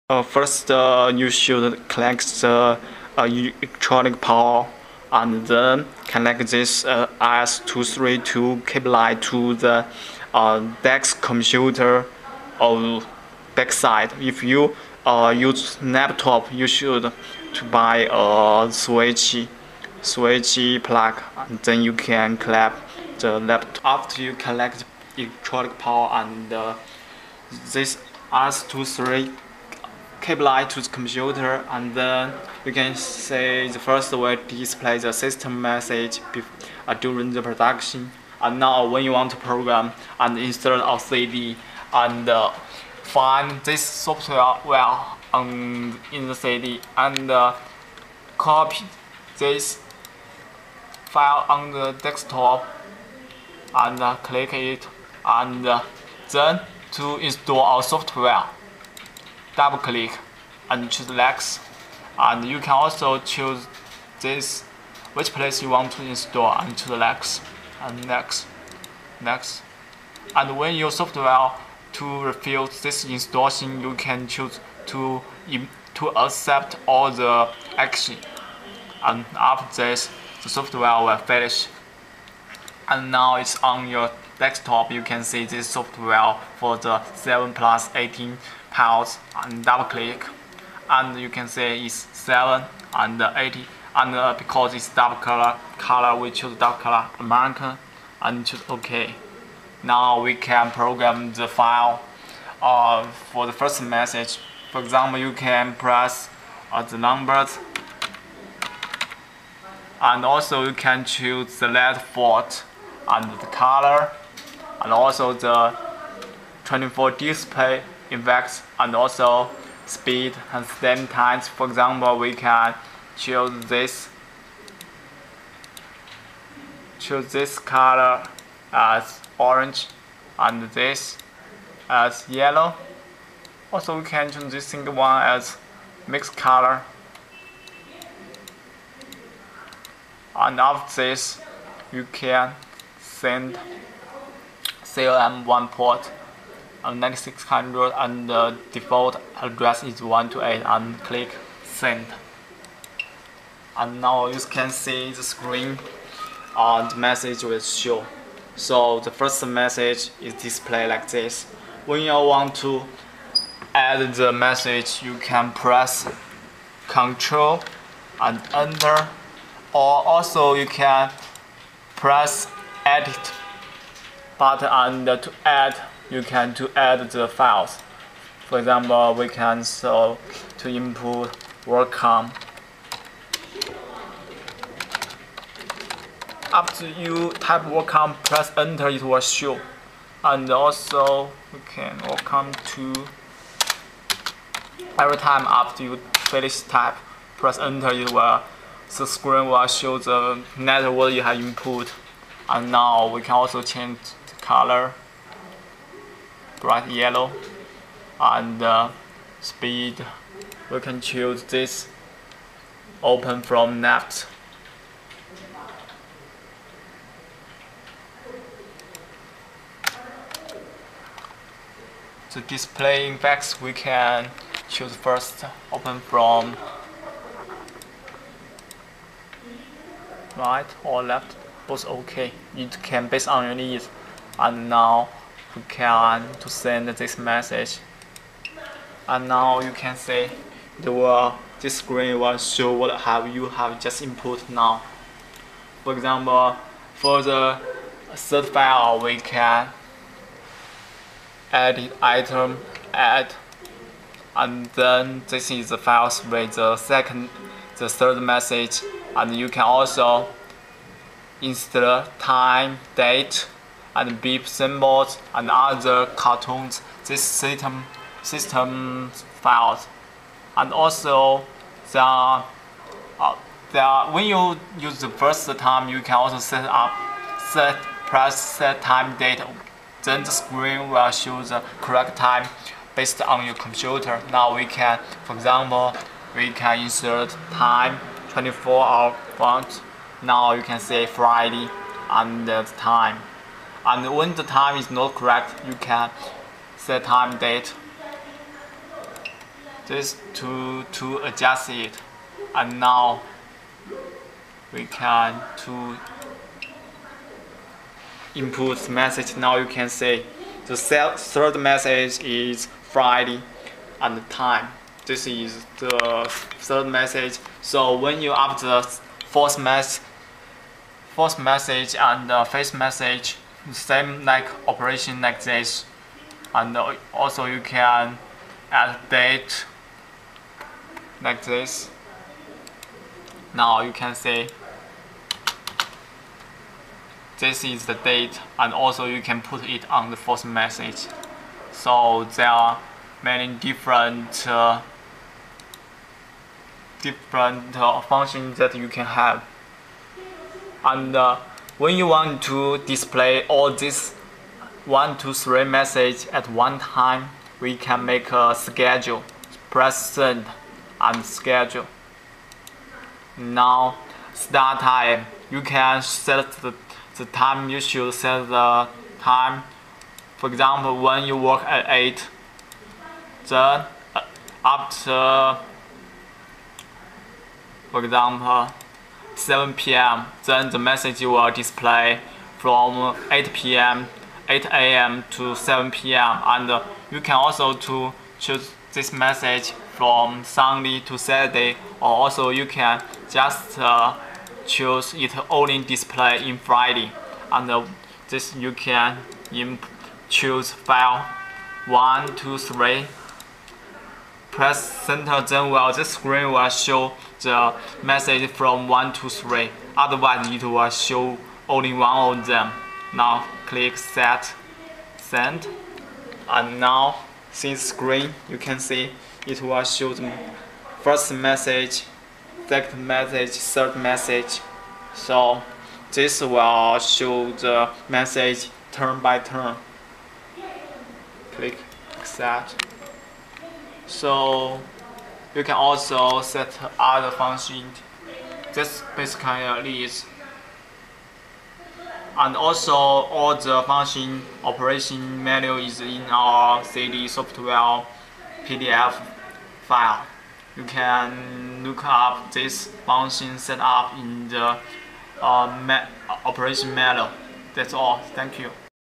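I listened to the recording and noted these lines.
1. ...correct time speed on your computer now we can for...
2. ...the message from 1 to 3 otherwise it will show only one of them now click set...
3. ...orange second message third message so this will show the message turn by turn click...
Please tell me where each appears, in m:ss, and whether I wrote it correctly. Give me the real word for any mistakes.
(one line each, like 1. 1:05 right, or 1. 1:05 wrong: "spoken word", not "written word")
1. 4:41 wrong: "based", not "speed"
2. 6:47 right
3. 7:01 wrong: "message", not "orange".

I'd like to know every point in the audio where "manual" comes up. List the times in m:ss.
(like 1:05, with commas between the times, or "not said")
7:25, 7:36.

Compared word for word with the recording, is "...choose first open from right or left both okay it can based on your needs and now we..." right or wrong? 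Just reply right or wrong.
right.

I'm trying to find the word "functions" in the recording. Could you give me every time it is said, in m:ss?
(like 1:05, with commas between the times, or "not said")
5:48, 7:17, 7:23, 7:33.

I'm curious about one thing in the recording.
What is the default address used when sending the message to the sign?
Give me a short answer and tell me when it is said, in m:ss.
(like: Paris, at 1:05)
128, at 2:30.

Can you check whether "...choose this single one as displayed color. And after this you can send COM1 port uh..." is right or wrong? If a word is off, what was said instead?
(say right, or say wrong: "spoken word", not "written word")
wrong: "mixed", not "displayed".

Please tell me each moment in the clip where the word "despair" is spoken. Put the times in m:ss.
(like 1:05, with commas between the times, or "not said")
not said.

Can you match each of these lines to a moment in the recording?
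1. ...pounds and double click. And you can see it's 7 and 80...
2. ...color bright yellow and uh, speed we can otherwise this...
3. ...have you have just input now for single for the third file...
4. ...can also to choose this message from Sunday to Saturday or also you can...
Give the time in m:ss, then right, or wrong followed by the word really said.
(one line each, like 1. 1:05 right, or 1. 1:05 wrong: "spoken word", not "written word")
1. 1:28 right
2. 3:24 wrong: "choose", not "otherwise"
3. 4:03 wrong: "example", not "single"
4. 6:27 right.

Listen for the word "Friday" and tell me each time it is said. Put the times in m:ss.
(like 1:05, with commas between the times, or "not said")
4:51, 5:12, 6:36.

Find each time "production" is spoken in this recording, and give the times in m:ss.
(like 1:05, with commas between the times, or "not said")
0:37.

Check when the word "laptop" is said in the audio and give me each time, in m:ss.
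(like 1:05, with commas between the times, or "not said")
0:15, 0:23.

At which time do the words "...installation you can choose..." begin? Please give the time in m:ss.
1:13.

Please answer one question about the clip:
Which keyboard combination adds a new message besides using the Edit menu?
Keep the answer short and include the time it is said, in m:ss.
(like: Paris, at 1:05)
Control and Enter, at 2:46.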